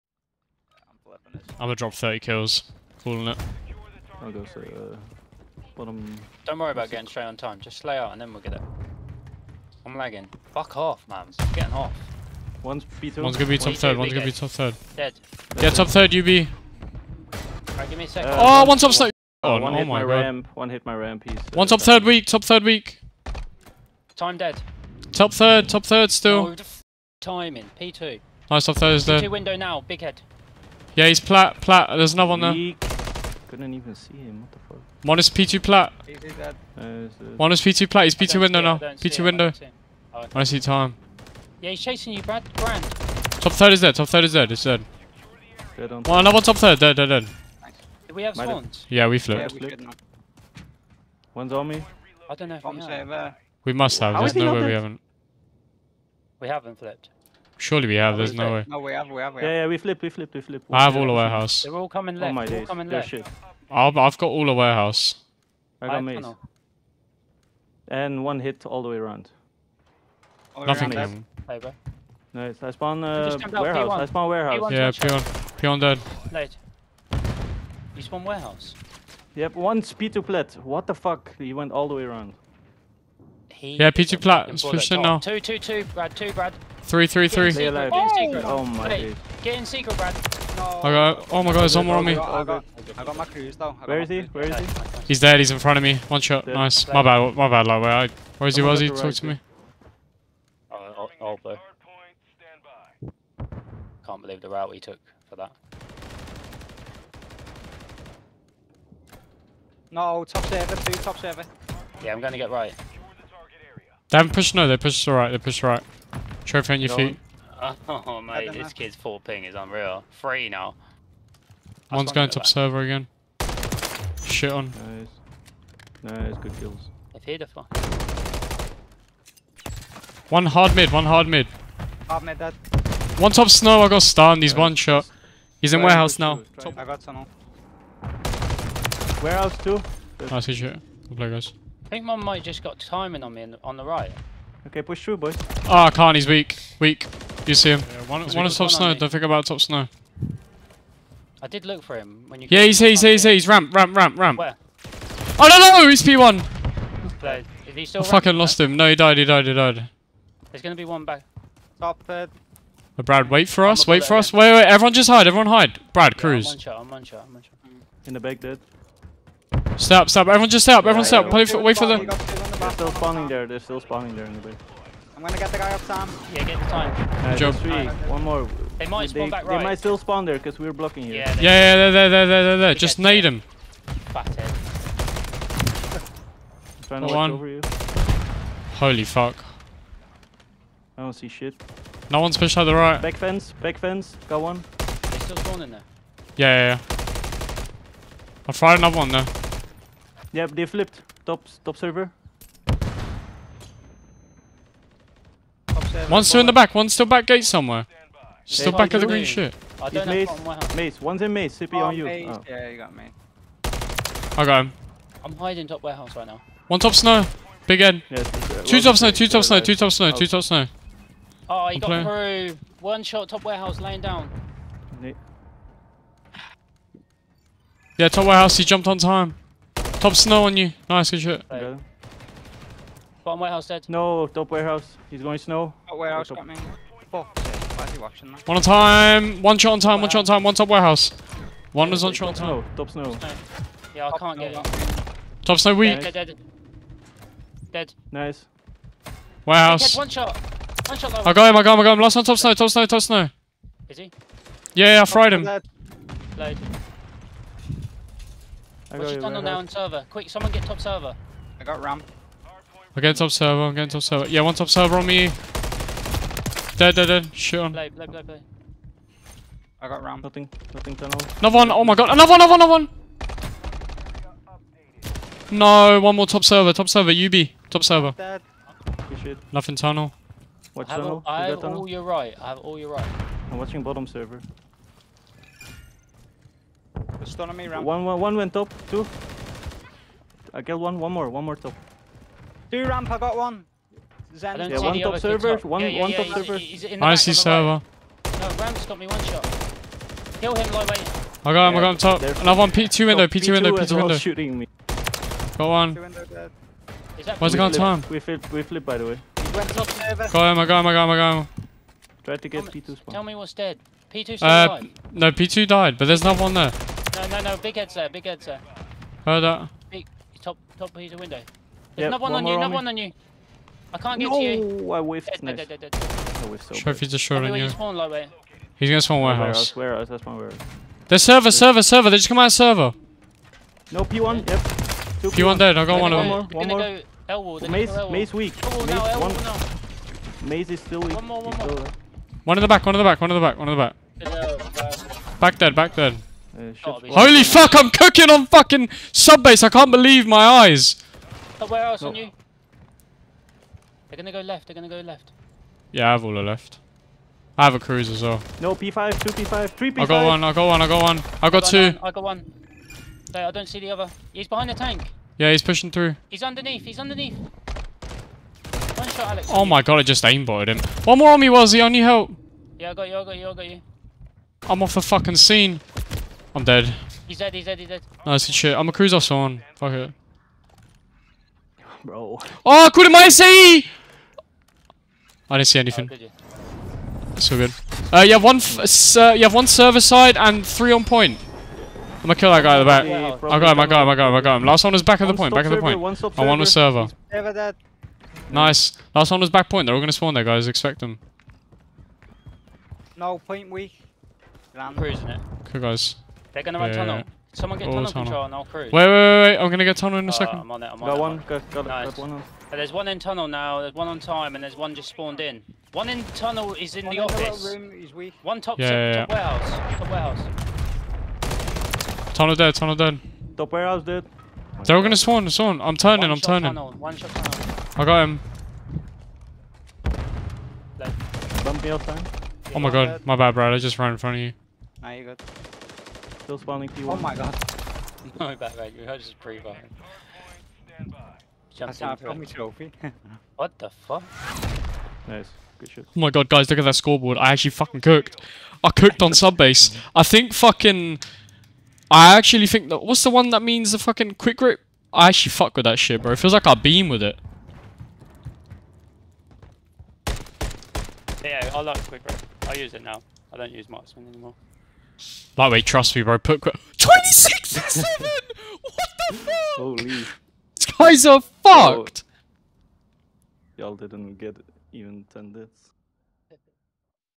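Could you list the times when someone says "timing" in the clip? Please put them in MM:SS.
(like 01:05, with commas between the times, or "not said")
00:27, 02:22.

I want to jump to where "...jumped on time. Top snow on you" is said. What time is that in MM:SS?
03:48.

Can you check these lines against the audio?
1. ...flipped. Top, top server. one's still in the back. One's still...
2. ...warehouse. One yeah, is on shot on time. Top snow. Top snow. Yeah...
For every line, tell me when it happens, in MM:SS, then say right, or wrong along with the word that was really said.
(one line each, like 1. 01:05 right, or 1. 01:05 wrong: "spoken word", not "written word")
1. 03:20 right
2. 04:00 right.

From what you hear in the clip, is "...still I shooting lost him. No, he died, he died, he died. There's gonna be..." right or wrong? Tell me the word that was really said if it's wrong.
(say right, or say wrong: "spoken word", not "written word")
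wrong: "fucking", not "shooting".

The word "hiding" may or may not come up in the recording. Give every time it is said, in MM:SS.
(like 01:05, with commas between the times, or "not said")
03:35.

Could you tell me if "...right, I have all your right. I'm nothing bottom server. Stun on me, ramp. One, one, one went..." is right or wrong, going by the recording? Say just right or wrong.
wrong.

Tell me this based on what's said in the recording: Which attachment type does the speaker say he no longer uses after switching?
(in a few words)
Marksman.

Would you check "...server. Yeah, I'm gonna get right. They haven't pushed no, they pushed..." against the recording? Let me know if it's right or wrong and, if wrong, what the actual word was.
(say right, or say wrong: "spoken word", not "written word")
right.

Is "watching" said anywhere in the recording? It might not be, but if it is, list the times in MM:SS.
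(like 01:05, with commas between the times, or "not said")
03:57, 04:43.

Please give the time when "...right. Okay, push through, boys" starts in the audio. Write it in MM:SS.
02:23.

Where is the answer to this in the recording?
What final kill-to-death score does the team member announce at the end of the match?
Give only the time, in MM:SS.
07:46.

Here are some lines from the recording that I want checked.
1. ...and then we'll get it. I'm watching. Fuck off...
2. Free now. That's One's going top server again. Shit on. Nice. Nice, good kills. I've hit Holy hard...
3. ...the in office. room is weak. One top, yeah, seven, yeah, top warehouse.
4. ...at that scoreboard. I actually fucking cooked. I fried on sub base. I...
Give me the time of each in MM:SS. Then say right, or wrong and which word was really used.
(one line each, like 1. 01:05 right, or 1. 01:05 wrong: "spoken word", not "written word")
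1. 00:08 wrong: "lagging", not "watching"
2. 02:00 wrong: "One", not "Holy"
3. 06:57 wrong: "six", not "seven"
4. 07:26 wrong: "cooked", not "fried".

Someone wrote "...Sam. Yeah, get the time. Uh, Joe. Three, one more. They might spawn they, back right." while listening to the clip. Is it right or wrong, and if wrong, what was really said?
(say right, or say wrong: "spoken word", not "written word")
right.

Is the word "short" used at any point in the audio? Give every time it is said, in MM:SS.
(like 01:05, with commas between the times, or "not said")
05:27.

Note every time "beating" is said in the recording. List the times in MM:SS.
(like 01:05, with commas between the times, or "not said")
not said.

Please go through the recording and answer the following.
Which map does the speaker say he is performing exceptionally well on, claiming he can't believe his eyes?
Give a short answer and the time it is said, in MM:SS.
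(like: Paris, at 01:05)
Sub base, at 05:49.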